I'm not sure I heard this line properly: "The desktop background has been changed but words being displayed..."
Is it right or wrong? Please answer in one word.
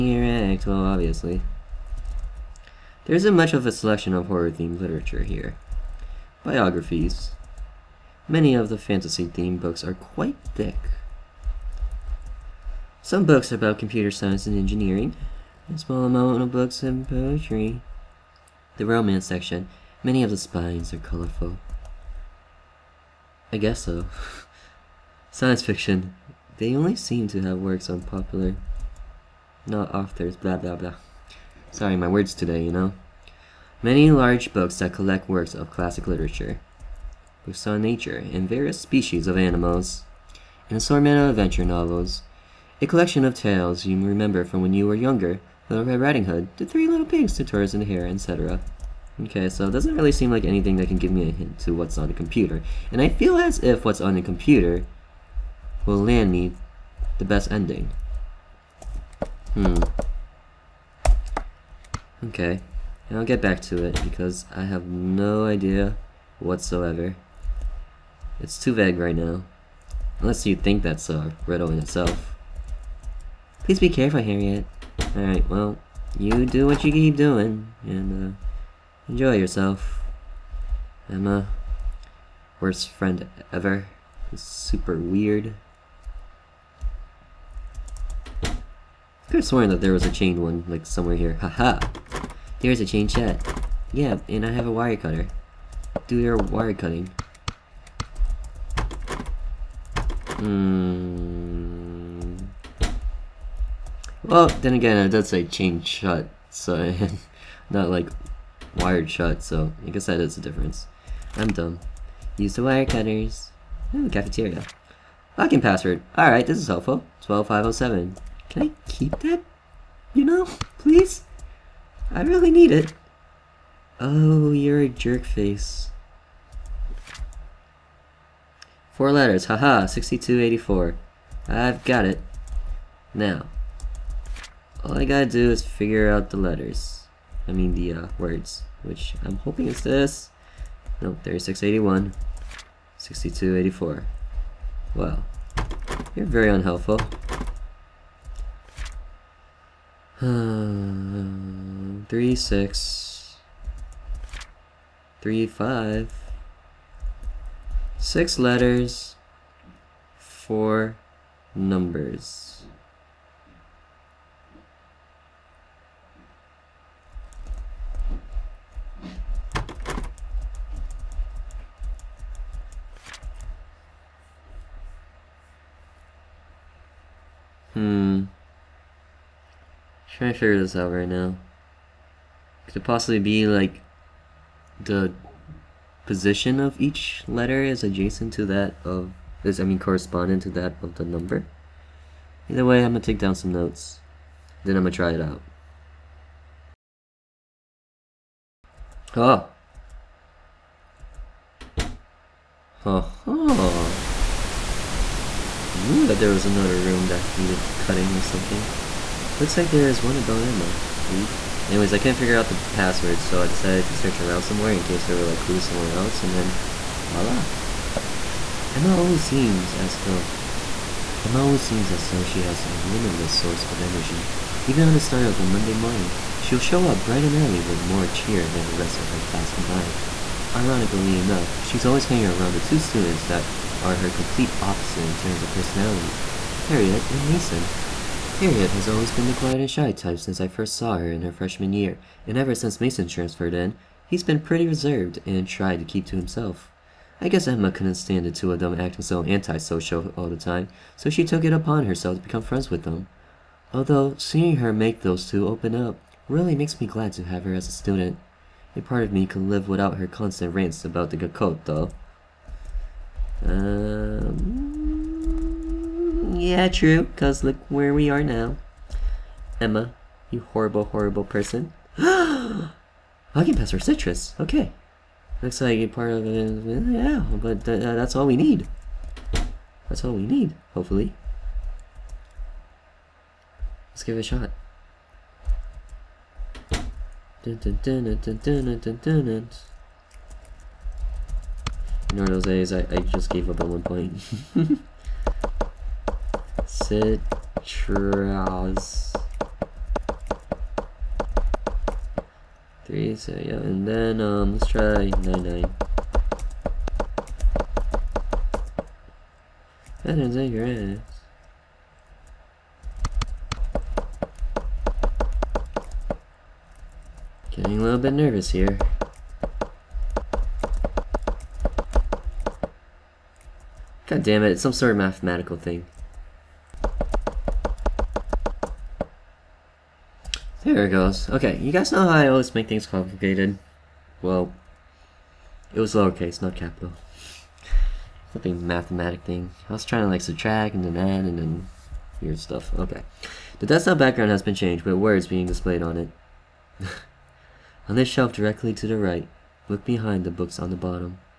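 right.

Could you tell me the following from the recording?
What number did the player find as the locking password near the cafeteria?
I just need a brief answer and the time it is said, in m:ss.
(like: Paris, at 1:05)
12507, at 1:57.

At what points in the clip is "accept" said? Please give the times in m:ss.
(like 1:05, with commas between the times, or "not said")
not said.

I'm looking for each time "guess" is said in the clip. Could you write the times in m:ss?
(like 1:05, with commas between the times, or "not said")
0:23, 1:49, 4:07.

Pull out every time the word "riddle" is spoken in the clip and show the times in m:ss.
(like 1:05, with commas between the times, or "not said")
1:11.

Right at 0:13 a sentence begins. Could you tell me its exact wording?
Some books about computer science and engineering, a small amount of books and poetry.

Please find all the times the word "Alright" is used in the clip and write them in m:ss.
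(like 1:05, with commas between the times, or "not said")
1:15, 1:56.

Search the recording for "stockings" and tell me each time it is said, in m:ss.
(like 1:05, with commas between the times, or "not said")
not said.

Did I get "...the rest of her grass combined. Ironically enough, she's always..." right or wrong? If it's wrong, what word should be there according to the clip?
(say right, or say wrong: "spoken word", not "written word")
wrong: "class", not "grass".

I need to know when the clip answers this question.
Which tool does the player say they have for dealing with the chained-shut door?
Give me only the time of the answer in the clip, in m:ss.
1:34.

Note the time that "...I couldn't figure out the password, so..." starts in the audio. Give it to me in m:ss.
3:31.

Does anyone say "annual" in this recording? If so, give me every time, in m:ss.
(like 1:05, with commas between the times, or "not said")
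not said.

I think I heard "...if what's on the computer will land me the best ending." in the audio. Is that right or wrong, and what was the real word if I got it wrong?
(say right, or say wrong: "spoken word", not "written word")
right.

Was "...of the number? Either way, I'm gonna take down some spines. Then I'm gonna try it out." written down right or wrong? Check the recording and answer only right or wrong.
wrong.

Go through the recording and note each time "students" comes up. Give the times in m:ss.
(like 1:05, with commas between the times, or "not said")
3:52, 4:17.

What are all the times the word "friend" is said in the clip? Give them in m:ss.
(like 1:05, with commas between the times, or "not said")
1:22, 4:12.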